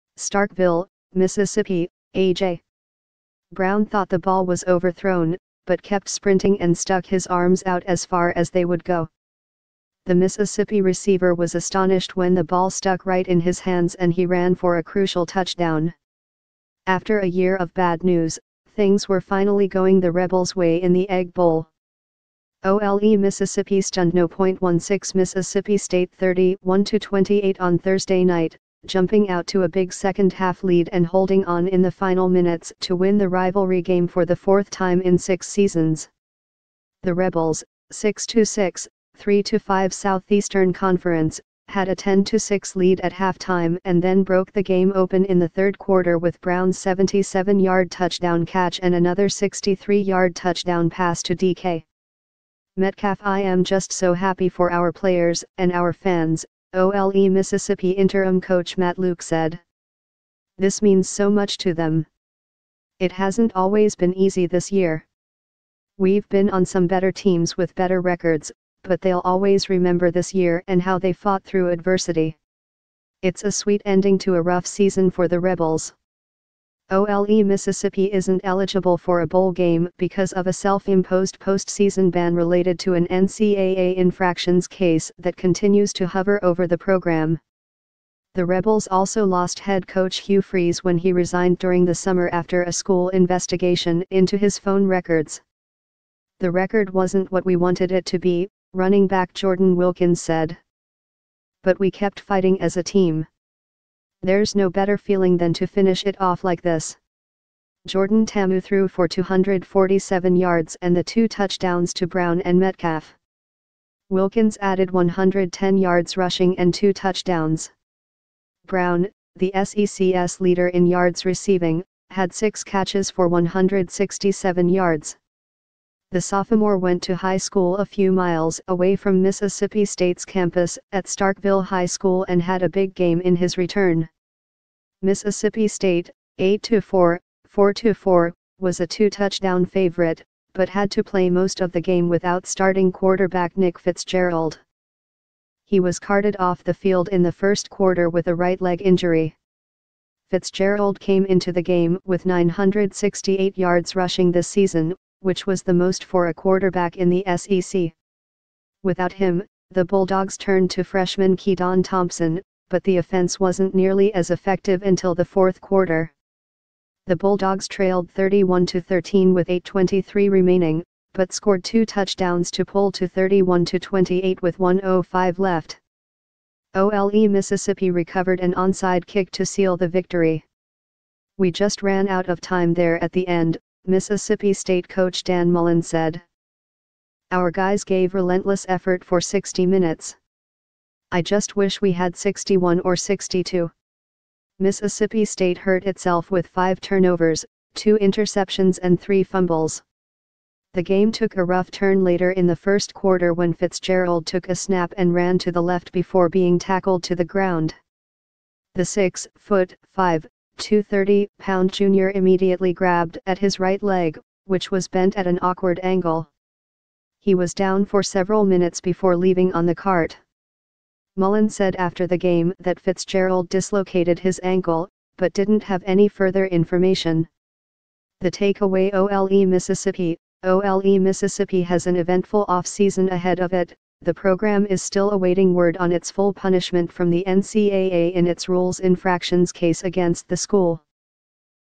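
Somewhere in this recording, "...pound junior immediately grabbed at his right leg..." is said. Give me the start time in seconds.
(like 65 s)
211 s.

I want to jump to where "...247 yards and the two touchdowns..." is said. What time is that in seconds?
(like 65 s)
109 s.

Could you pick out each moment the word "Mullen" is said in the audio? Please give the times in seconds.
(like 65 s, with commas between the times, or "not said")
185 s, 221 s.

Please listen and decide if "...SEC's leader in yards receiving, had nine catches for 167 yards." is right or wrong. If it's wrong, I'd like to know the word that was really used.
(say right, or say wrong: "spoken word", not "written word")
wrong: "six", not "nine".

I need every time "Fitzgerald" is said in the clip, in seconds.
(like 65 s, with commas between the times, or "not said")
143 s, 150 s, 203 s, 222 s.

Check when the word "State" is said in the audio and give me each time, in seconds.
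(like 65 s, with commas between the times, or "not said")
25 s, 129 s, 135 s, 184 s, 195 s.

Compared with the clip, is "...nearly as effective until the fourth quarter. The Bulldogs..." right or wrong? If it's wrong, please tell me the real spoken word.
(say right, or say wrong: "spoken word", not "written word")
right.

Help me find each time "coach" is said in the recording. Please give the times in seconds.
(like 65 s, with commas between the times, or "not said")
58 s, 89 s, 184 s.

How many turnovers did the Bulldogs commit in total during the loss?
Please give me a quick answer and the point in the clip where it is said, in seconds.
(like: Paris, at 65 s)
5, at 196 s.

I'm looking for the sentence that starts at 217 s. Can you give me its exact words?
He was down for several minutes before leaving on the cart.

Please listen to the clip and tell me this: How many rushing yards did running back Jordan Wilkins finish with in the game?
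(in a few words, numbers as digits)
110.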